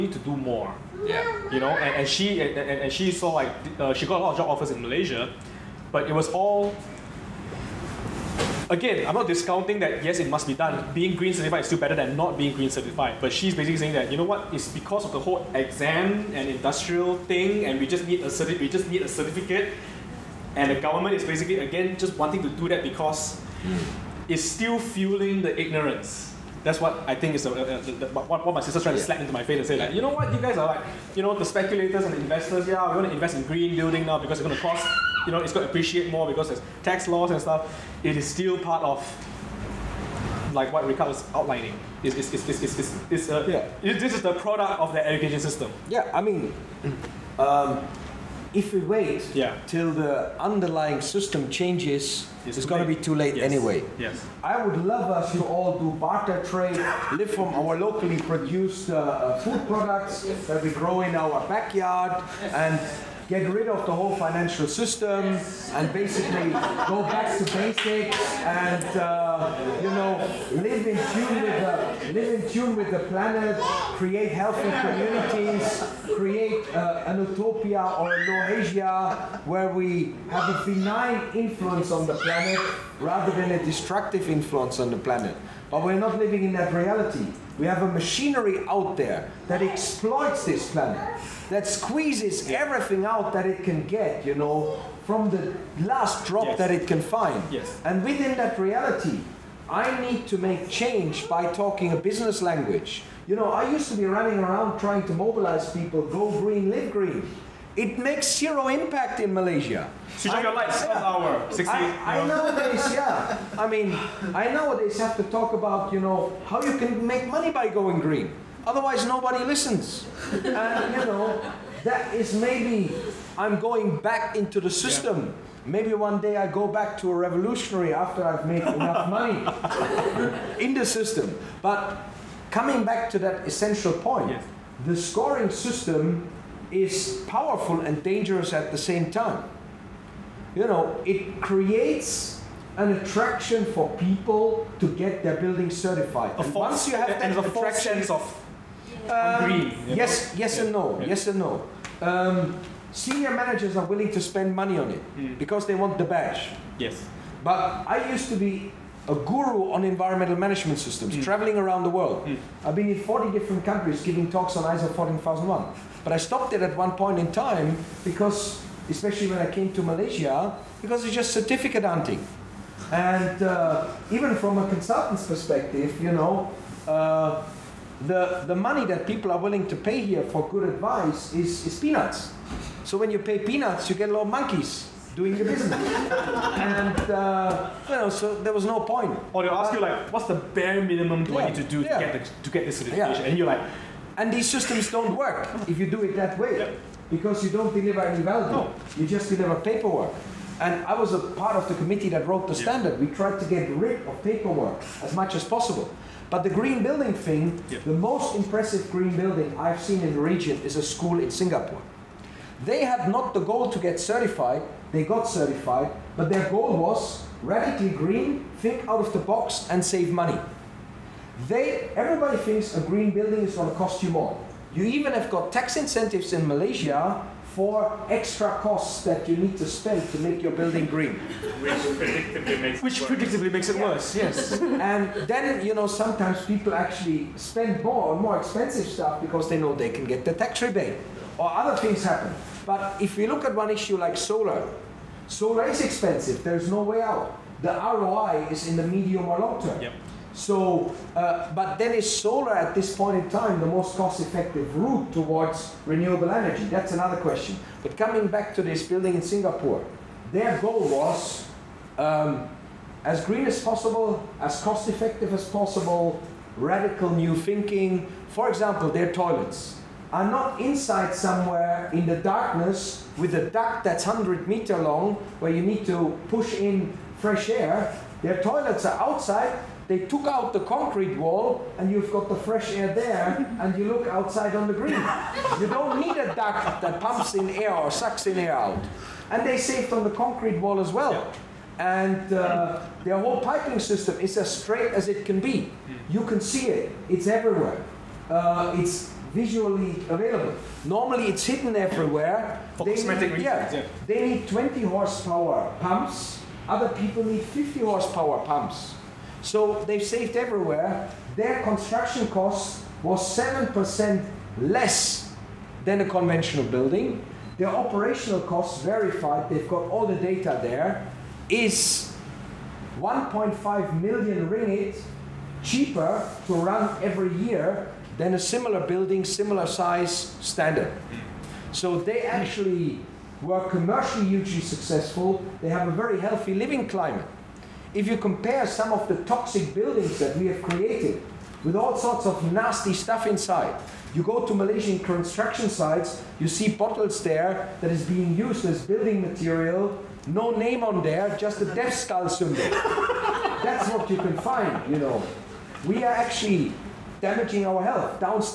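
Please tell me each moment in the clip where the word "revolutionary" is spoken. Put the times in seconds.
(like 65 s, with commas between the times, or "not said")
127 s.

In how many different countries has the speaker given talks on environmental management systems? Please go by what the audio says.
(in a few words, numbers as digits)
40.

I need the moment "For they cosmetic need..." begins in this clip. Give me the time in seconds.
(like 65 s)
302 s.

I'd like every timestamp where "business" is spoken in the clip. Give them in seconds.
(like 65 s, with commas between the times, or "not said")
101 s, 185 s.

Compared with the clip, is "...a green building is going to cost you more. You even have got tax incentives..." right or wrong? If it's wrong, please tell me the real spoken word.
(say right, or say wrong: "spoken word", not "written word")
right.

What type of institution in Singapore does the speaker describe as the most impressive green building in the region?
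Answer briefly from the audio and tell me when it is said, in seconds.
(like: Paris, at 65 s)
A school, at 210 s.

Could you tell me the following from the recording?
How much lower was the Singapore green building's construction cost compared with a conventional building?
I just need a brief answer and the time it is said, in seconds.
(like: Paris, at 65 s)
7%, at 313 s.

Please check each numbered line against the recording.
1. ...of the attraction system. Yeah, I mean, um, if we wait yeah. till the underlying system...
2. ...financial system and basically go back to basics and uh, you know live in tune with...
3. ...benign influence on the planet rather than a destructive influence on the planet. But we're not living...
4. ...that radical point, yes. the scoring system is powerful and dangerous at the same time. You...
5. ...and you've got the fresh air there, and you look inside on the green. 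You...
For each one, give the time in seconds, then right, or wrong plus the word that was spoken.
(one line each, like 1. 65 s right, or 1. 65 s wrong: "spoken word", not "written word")
1. 44 s wrong: "education", not "attraction"
2. 64 s right
3. 80 s right
4. 133 s wrong: "essential", not "radical"
5. 281 s wrong: "outside", not "inside".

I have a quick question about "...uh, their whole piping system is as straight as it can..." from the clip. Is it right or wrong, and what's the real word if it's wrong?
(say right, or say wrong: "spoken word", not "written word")
right.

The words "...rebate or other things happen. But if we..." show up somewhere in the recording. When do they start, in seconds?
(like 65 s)
240 s.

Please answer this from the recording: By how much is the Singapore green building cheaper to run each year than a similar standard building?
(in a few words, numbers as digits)
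1.5 million ringgit.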